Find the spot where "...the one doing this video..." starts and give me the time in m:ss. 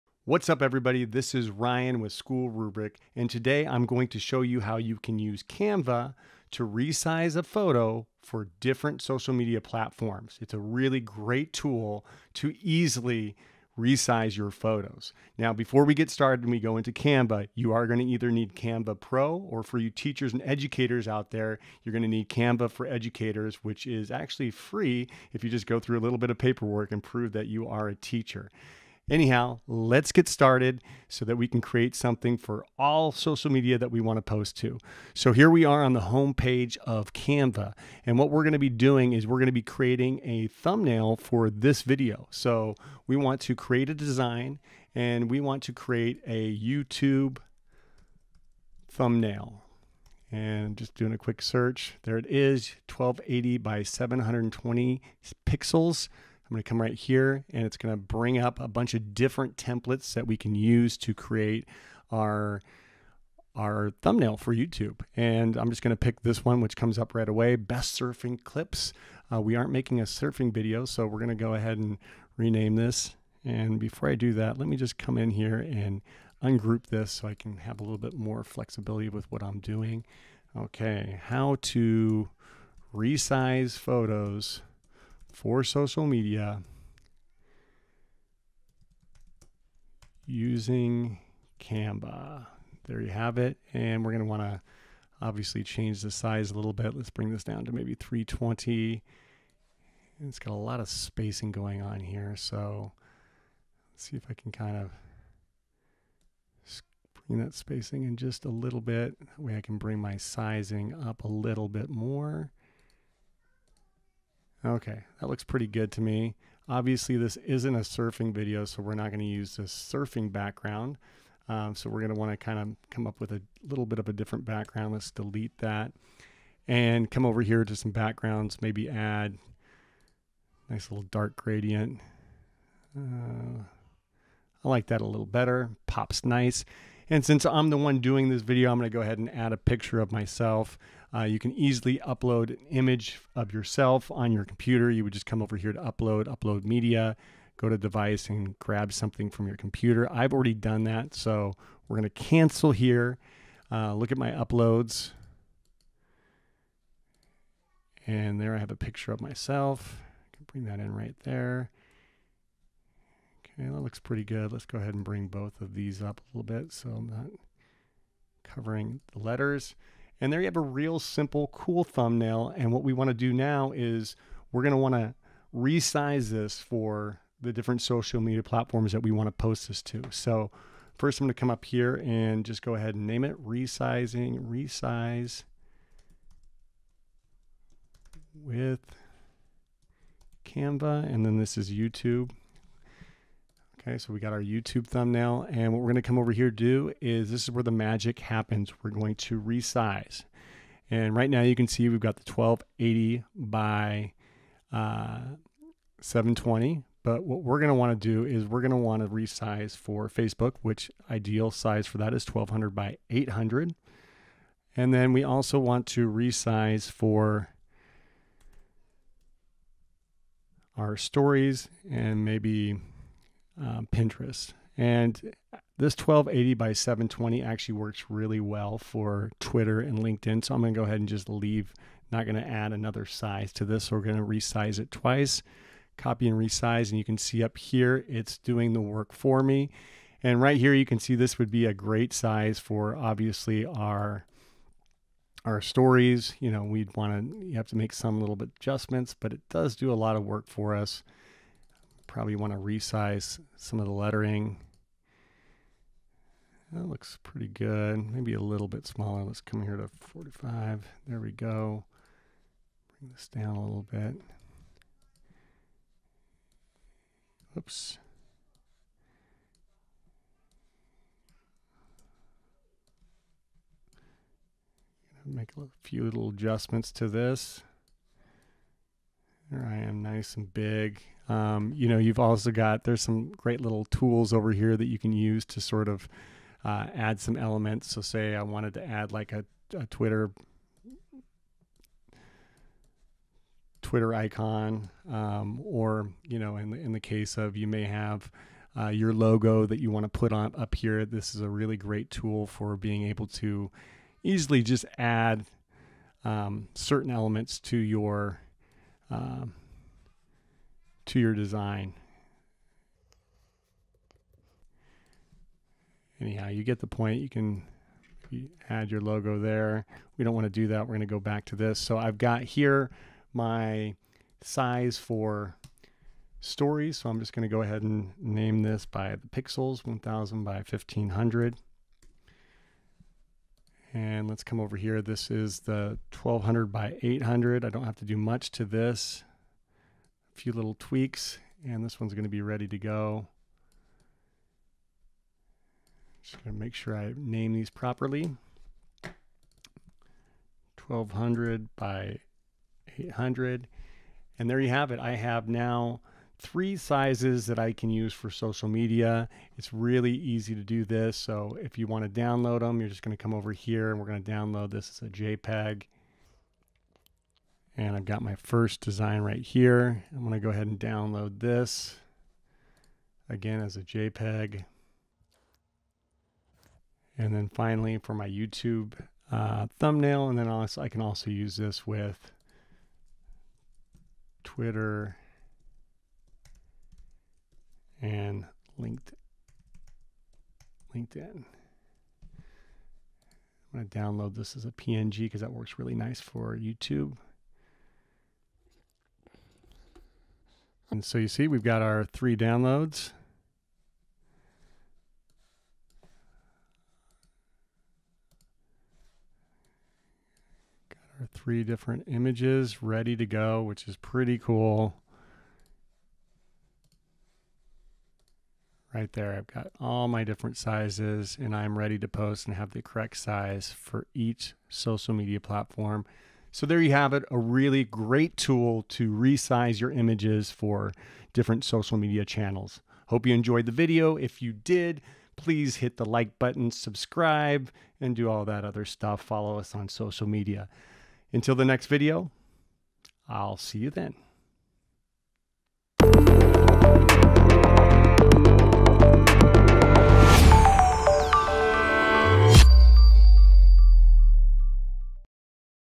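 2:17.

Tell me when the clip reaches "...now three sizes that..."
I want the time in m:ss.
5:55.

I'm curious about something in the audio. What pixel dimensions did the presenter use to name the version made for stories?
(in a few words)
1000 by 1500.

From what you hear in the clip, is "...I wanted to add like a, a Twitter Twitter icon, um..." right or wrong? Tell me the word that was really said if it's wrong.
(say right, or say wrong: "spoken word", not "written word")
right.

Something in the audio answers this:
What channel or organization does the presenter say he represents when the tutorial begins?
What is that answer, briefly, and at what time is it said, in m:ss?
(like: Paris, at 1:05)
School Rubric, at 0:02.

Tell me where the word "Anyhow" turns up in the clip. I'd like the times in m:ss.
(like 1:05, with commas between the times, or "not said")
0:29, 5:16.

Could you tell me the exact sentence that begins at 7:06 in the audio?
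So there you have it, a really great tool to resize your images for different social media channels.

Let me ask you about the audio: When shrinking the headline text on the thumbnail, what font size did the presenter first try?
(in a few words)
320.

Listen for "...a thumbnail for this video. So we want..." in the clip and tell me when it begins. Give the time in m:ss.
0:40.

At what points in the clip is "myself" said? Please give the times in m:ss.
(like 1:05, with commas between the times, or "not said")
2:20, 2:39.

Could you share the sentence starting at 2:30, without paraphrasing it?
I've already done that, so we're going to cancel here.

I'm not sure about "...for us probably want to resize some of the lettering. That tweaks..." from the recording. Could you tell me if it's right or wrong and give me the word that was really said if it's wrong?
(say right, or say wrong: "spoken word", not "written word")
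wrong: "looks", not "tweaks".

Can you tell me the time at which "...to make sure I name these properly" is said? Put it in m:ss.
5:46.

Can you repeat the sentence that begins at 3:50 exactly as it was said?
So I'm going to go ahead and just leave, not going to add another size to this.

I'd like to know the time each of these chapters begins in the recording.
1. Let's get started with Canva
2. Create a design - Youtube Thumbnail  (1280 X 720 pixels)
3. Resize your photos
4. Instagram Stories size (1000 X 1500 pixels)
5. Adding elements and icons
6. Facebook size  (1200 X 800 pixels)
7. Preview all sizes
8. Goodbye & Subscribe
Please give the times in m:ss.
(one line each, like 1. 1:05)
1. 0:30
2. 0:45
3. 3:15
4. 4:00
5. 4:45
6. 5:33
7. 6:50
8. 7:06.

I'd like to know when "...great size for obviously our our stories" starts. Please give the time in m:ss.
4:01.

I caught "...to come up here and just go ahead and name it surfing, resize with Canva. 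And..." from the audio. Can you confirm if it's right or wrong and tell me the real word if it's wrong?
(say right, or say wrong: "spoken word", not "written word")
wrong: "resizing", not "surfing".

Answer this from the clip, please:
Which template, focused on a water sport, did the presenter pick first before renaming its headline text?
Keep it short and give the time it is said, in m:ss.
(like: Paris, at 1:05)
best surfing clips, at 1:07.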